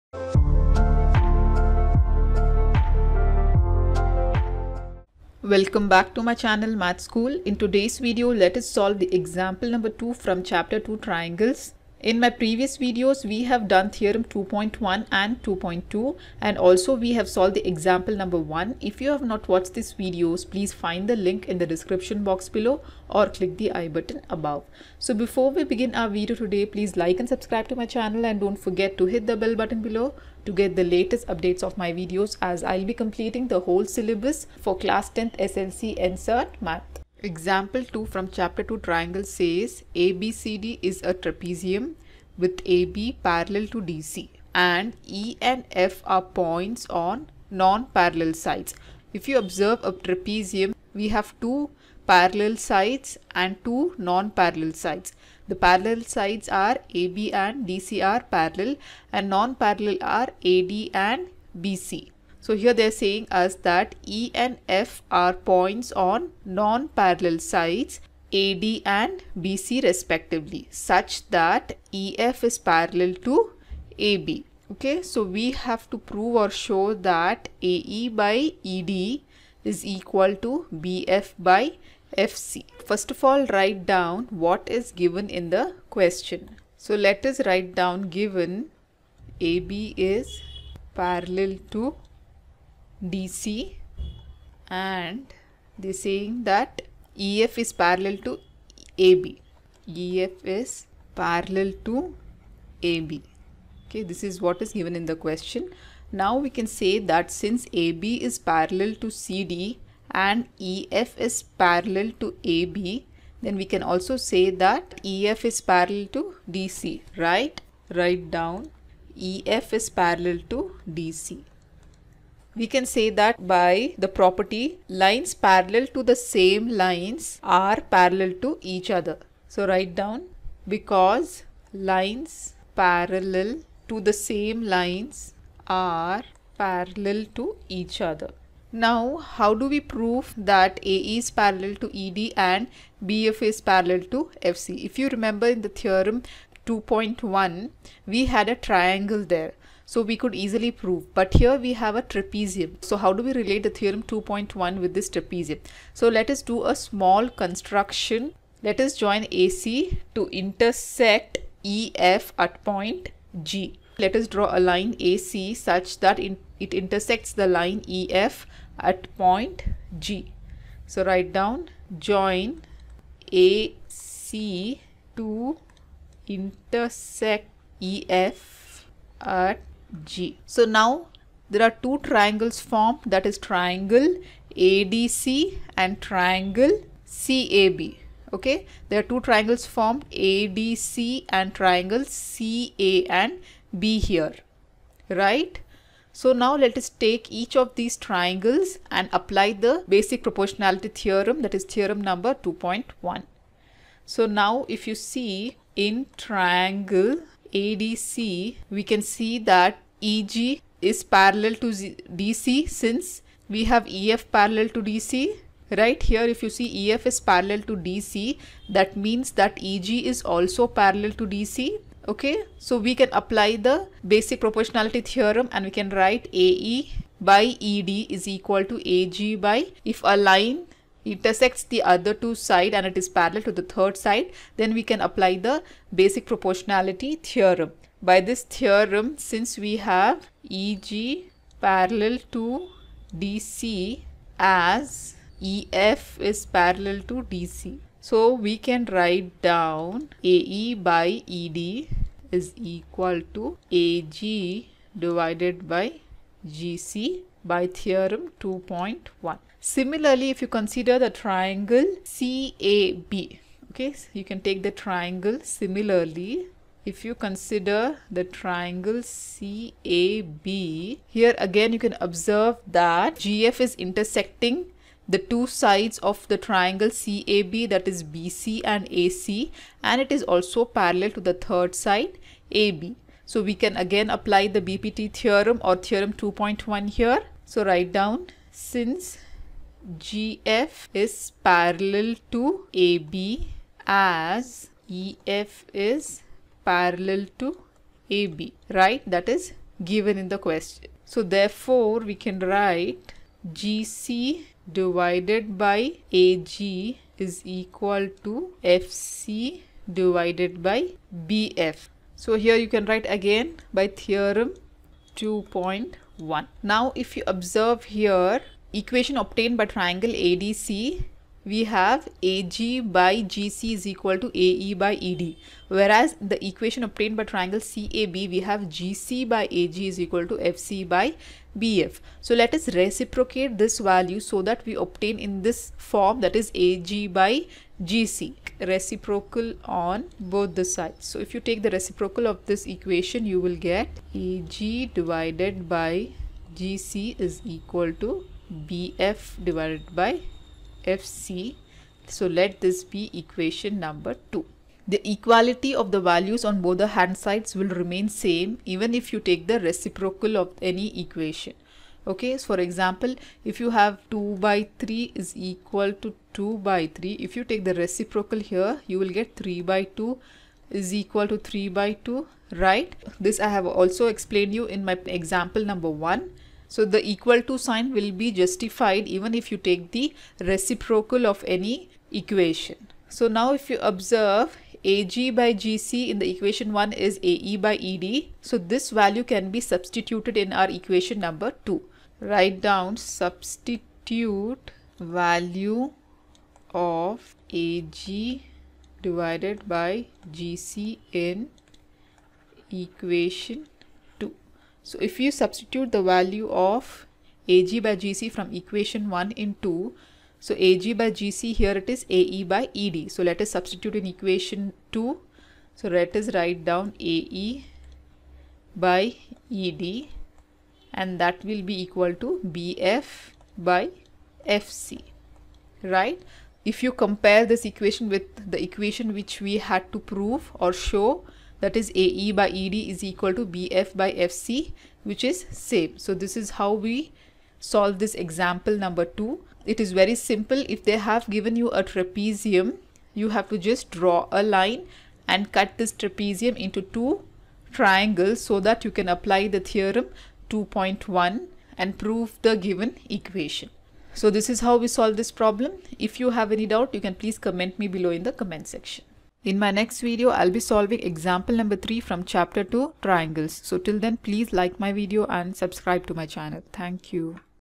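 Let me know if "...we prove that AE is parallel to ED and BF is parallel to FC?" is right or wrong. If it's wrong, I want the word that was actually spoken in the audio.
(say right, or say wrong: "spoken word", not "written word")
right.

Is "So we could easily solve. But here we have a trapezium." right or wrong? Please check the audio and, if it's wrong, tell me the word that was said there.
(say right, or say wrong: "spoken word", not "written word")
wrong: "prove", not "solve".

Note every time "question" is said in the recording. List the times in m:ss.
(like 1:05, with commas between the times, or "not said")
1:25, 1:45, 5:00.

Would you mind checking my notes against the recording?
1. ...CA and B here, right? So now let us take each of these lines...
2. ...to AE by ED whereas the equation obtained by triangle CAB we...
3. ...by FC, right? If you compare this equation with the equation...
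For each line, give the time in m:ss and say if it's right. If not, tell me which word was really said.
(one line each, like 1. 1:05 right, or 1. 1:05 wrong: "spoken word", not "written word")
1. 3:12 wrong: "triangles", not "lines"
2. 5:24 right
3. 7:03 right.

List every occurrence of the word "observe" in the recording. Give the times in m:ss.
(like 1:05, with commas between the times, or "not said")
0:49, 4:32, 5:17, 6:23.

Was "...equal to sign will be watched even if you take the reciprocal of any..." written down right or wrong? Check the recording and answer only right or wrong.
wrong.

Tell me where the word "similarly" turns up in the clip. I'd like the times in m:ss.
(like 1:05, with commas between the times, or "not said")
4:19, 4:25.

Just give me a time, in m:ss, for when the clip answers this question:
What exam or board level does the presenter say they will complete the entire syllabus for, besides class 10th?
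0:35.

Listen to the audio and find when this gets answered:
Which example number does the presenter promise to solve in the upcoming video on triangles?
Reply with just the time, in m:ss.
7:41.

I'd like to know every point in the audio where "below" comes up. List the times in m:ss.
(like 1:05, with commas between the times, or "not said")
0:22, 0:29, 7:37.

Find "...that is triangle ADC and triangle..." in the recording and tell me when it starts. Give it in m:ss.
3:03.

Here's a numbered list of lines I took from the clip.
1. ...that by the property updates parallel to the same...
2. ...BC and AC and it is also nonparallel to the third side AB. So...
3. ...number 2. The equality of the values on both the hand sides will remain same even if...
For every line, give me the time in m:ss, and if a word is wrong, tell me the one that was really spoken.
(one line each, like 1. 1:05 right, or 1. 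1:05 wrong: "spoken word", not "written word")
1. 2:03 wrong: "lines", not "updates"
2. 4:38 wrong: "parallel", not "nonparallel"
3. 5:53 right.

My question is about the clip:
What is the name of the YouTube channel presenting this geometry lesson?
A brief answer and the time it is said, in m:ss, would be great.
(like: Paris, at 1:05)
Math School, at 0:06.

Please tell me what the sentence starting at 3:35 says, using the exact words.
Right here, if you see EF is parallel to DC, that means that EG is also parallel to DC.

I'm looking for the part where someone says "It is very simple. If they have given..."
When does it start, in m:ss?
7:19.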